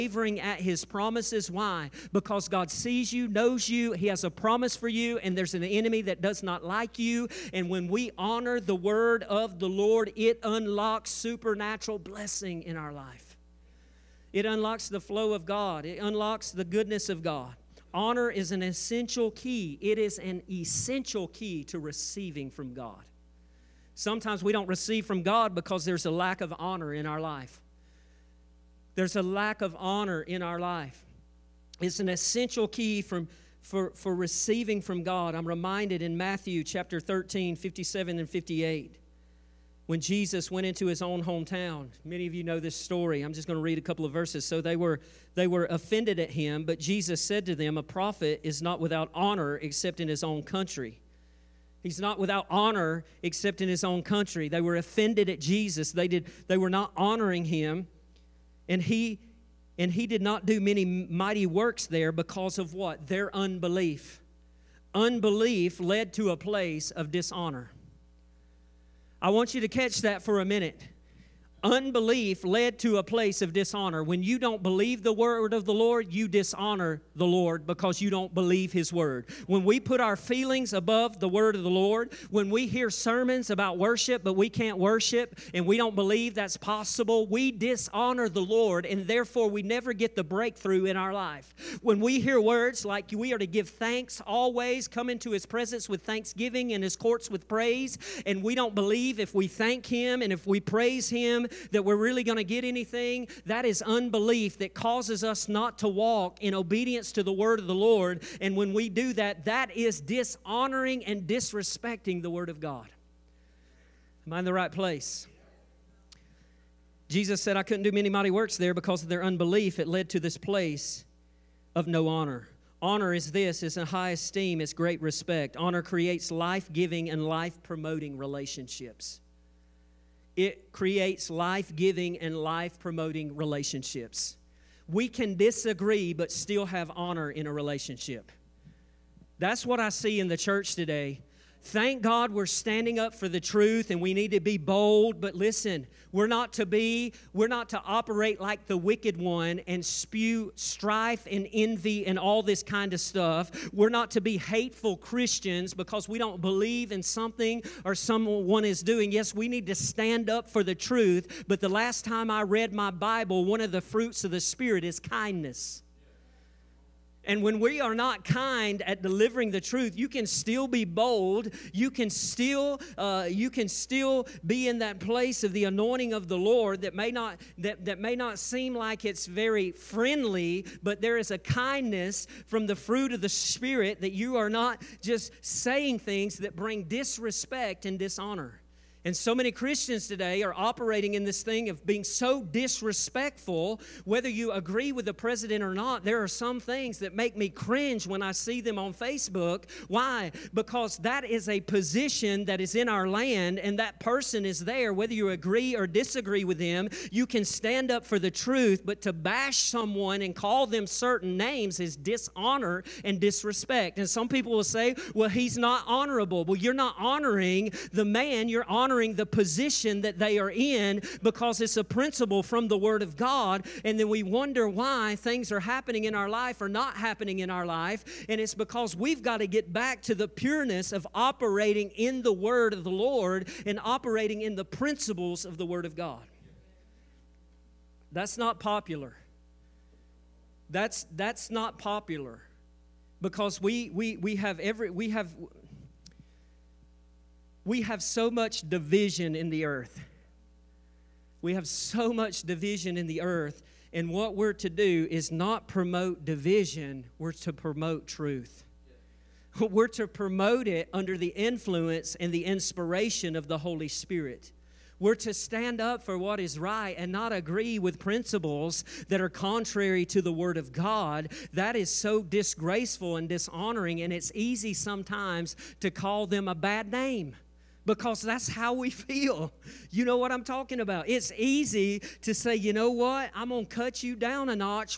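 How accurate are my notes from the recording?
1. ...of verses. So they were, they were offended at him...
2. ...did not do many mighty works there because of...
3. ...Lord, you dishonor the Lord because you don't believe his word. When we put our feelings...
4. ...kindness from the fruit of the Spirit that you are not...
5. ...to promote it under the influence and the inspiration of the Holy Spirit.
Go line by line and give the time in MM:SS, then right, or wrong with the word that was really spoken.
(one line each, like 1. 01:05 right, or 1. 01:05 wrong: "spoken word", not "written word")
1. 00:44 right
2. 01:00 right
3. 01:15 right
4. 03:01 right
5. 04:19 right.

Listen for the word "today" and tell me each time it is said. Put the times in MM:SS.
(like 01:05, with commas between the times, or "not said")
02:20, 03:10.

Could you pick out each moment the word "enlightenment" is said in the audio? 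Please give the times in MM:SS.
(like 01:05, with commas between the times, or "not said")
not said.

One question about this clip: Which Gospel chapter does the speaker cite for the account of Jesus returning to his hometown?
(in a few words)
Matthew 13.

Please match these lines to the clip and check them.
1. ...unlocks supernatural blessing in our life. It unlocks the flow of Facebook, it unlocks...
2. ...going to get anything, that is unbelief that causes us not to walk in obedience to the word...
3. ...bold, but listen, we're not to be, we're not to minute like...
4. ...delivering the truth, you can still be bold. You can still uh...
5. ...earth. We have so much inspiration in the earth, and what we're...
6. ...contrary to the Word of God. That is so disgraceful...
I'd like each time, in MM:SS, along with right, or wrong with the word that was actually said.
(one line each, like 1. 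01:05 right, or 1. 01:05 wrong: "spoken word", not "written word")
1. 00:10 wrong: "God", not "Facebook"
2. 01:42 right
3. 02:24 wrong: "operate", not "minute"
4. 02:49 right
5. 04:09 wrong: "division", not "inspiration"
6. 04:29 right.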